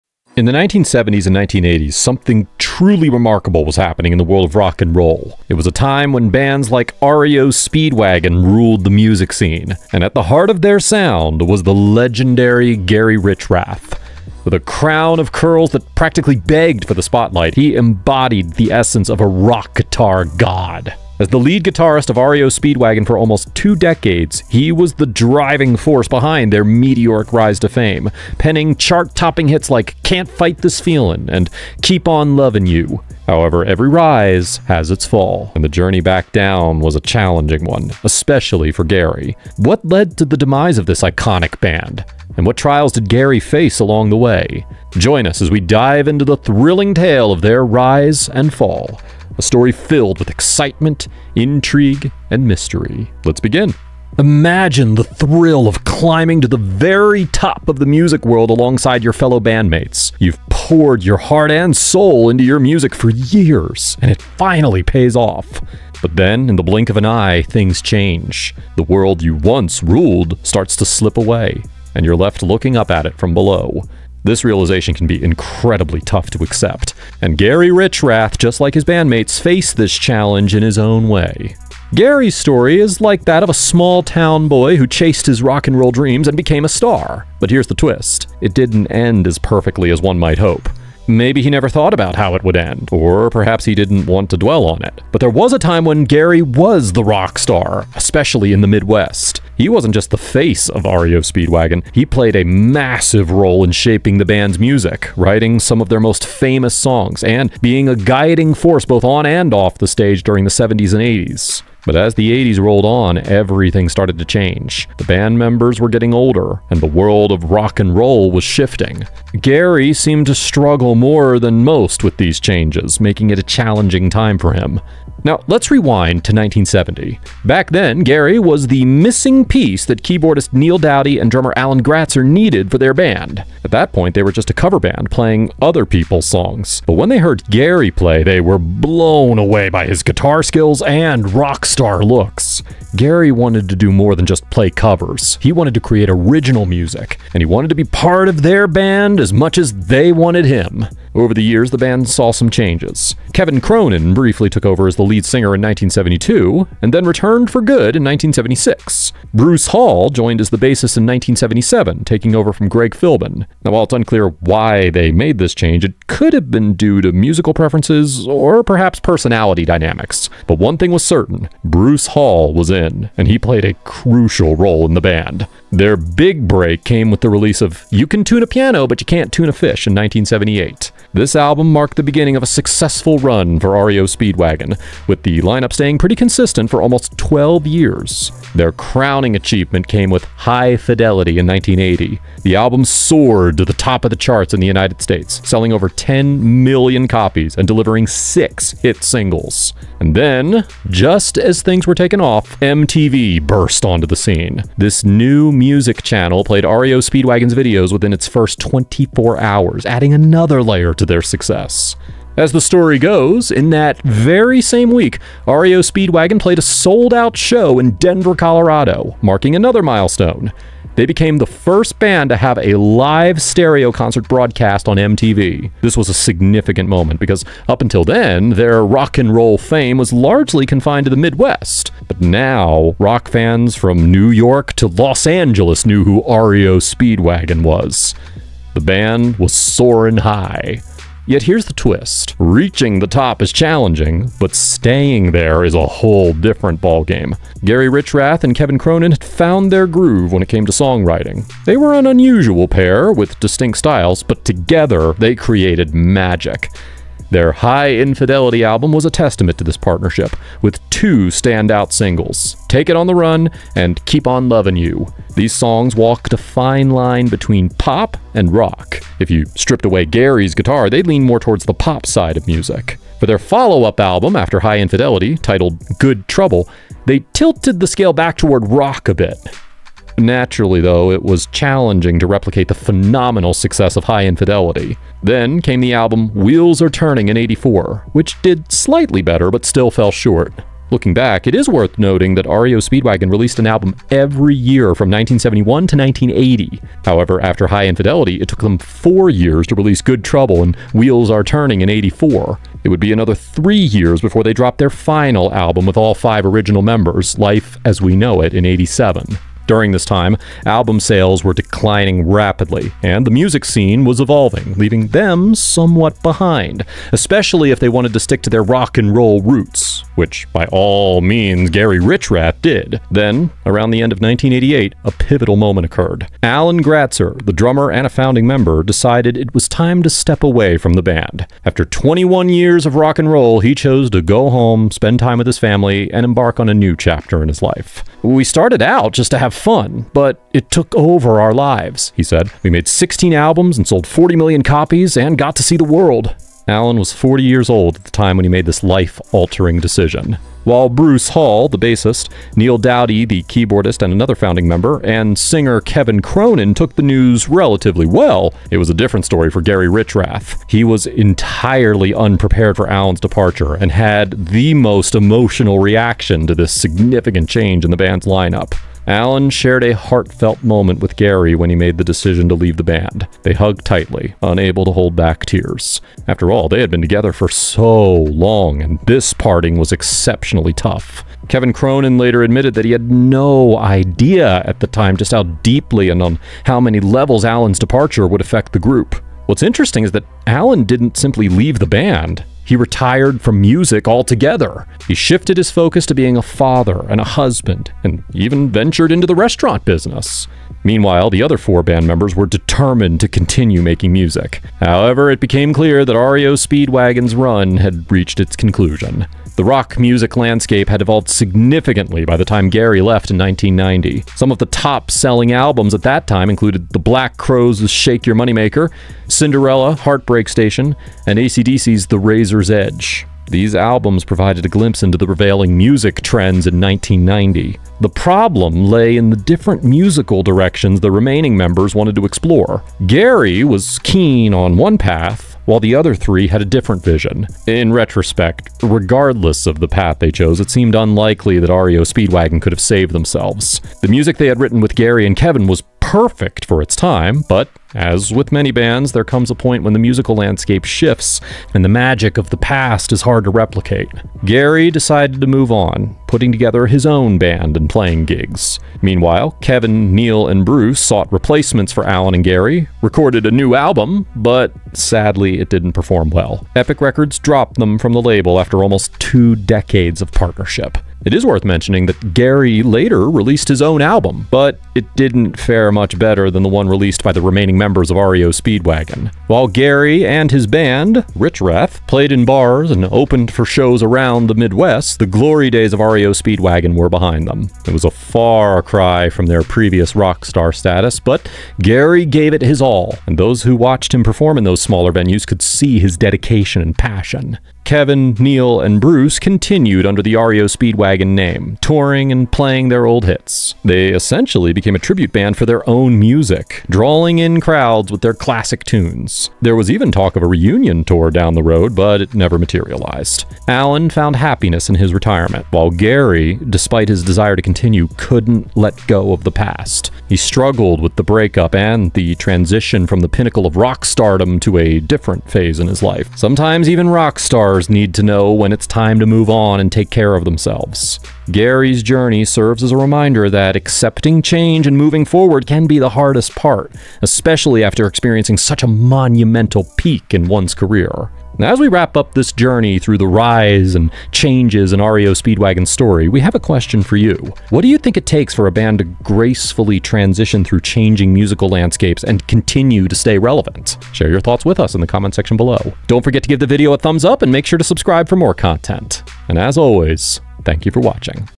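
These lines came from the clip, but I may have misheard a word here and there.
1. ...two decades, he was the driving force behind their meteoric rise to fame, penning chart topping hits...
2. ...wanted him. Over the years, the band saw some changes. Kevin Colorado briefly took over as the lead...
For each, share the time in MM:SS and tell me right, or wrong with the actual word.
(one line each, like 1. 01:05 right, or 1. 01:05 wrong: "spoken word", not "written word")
1. 00:23 right
2. 02:30 wrong: "Cronin", not "Colorado".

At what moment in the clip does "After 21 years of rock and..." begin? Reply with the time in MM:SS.
05:31.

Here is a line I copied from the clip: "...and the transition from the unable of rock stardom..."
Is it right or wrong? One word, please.
wrong.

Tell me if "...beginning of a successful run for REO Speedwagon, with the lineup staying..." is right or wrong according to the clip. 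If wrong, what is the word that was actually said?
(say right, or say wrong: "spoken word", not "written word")
right.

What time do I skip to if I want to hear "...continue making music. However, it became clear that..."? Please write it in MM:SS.
06:43.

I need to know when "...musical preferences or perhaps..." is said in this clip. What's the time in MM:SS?
02:47.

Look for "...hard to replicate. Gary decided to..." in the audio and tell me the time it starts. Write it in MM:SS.
07:33.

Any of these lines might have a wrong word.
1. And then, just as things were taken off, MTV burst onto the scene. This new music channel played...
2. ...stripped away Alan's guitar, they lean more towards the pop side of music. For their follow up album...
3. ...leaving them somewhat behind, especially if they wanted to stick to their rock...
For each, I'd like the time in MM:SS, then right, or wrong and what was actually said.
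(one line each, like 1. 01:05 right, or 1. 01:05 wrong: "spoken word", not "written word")
1. 03:20 right
2. 04:29 wrong: "Gary", not "Alan"
3. 05:14 right.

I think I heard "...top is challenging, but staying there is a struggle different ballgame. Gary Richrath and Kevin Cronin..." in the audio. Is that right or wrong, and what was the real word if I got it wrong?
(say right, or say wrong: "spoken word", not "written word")
wrong: "whole", not "struggle".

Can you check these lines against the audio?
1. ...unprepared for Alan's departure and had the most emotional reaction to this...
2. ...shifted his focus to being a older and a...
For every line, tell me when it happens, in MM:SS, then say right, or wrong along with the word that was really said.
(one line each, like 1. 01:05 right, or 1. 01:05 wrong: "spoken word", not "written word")
1. 06:02 right
2. 06:35 wrong: "father", not "older".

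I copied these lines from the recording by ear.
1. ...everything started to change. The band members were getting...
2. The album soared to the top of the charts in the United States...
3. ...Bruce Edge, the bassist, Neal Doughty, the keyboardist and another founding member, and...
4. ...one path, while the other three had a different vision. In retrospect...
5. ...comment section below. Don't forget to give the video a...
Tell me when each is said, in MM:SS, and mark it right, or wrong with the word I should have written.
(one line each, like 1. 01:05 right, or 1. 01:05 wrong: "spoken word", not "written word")
1. 01:53 right
2. 03:12 right
3. 05:50 wrong: "Hall", not "Edge"
4. 07:14 right
5. 09:15 right.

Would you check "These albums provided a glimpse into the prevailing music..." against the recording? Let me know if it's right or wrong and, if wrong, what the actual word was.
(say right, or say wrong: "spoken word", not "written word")
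right.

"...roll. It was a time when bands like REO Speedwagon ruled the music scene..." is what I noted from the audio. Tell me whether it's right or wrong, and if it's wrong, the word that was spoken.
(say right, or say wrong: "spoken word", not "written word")
right.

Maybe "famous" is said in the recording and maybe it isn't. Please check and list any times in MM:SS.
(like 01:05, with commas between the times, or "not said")
01:46.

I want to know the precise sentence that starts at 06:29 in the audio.
What's interesting is that Alan didn't simply leave the band.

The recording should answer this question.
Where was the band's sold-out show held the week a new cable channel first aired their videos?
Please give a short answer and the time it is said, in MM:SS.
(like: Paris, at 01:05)
Denver, at 03:37.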